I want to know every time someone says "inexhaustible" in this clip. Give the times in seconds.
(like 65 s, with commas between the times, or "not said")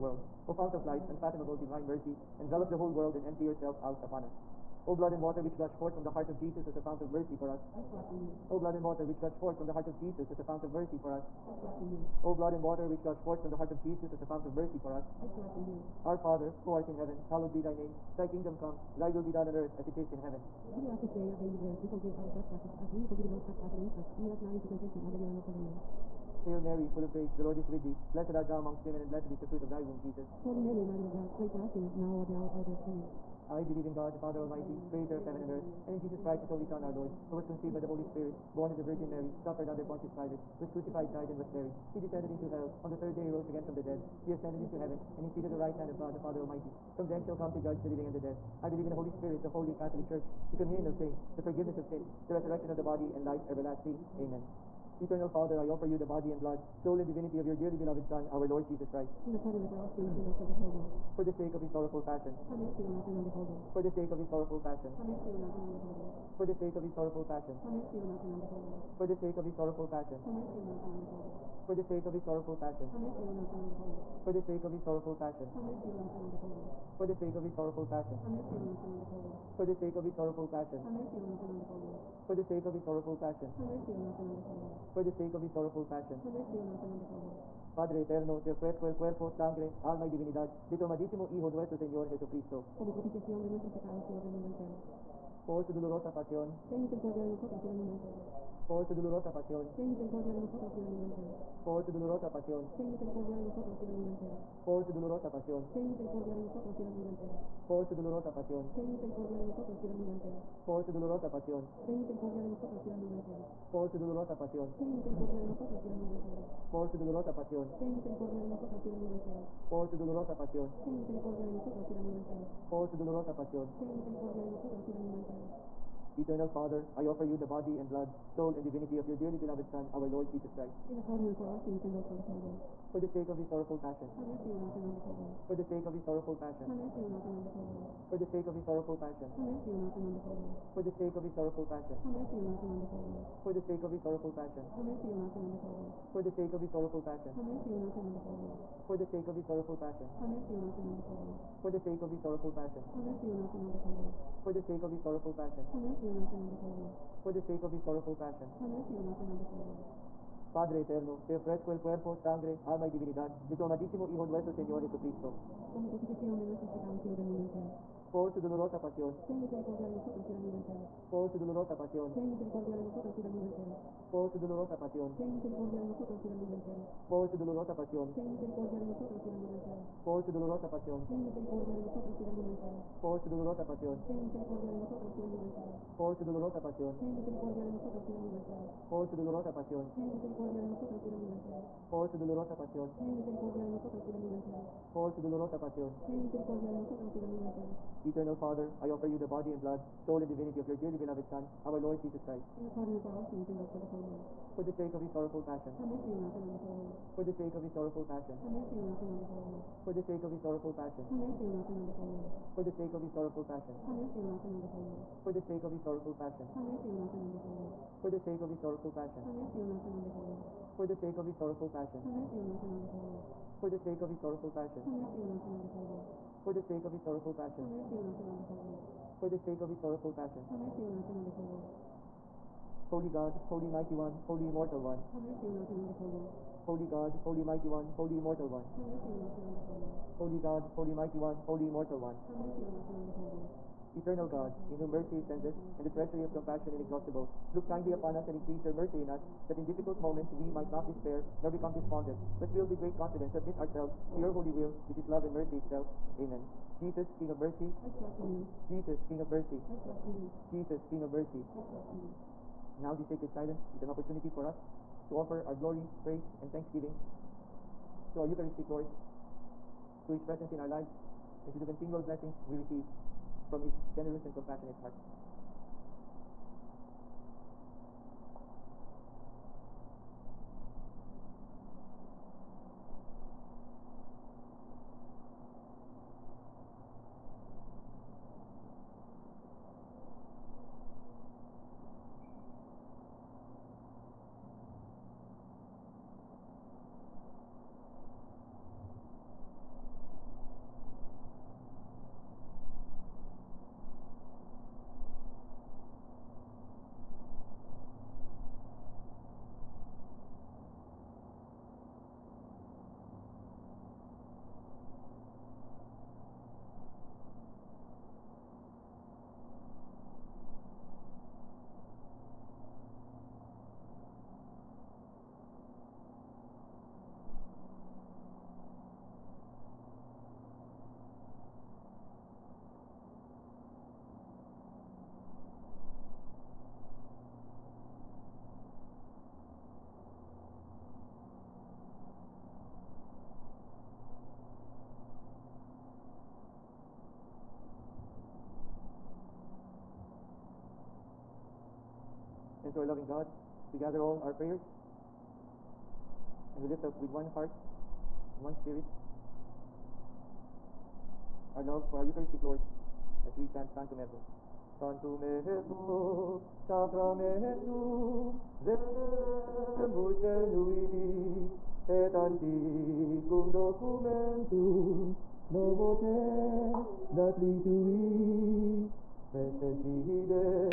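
246 s.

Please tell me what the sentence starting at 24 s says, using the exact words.
Lead us not into temptation, but deliver us from the evil.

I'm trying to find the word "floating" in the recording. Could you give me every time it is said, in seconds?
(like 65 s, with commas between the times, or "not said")
not said.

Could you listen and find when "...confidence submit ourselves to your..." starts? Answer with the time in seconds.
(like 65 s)
252 s.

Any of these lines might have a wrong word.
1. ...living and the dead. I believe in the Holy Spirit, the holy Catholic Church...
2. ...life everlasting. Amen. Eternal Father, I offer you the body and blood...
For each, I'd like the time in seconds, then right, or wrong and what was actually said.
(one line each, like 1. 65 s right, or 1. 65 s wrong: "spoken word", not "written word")
1. 47 s right
2. 53 s right.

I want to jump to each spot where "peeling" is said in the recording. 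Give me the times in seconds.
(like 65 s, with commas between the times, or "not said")
not said.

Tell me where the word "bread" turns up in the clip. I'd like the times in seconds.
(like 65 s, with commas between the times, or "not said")
21 s.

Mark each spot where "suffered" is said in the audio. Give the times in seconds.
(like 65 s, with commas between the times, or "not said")
39 s.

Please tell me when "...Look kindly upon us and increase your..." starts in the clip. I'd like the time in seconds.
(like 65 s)
247 s.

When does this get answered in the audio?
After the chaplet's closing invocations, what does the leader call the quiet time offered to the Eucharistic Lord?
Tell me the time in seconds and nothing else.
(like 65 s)
263 s.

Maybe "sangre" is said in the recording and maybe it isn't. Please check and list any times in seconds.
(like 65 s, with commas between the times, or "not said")
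89 s, 162 s.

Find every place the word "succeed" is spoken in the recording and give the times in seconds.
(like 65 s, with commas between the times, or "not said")
not said.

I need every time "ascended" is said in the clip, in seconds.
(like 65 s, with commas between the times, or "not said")
44 s.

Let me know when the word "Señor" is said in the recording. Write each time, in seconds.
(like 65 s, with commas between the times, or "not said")
91 s, 164 s.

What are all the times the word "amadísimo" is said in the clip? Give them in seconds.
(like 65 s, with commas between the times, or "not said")
90 s, 163 s.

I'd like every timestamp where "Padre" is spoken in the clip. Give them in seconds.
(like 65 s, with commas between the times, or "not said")
87 s, 160 s.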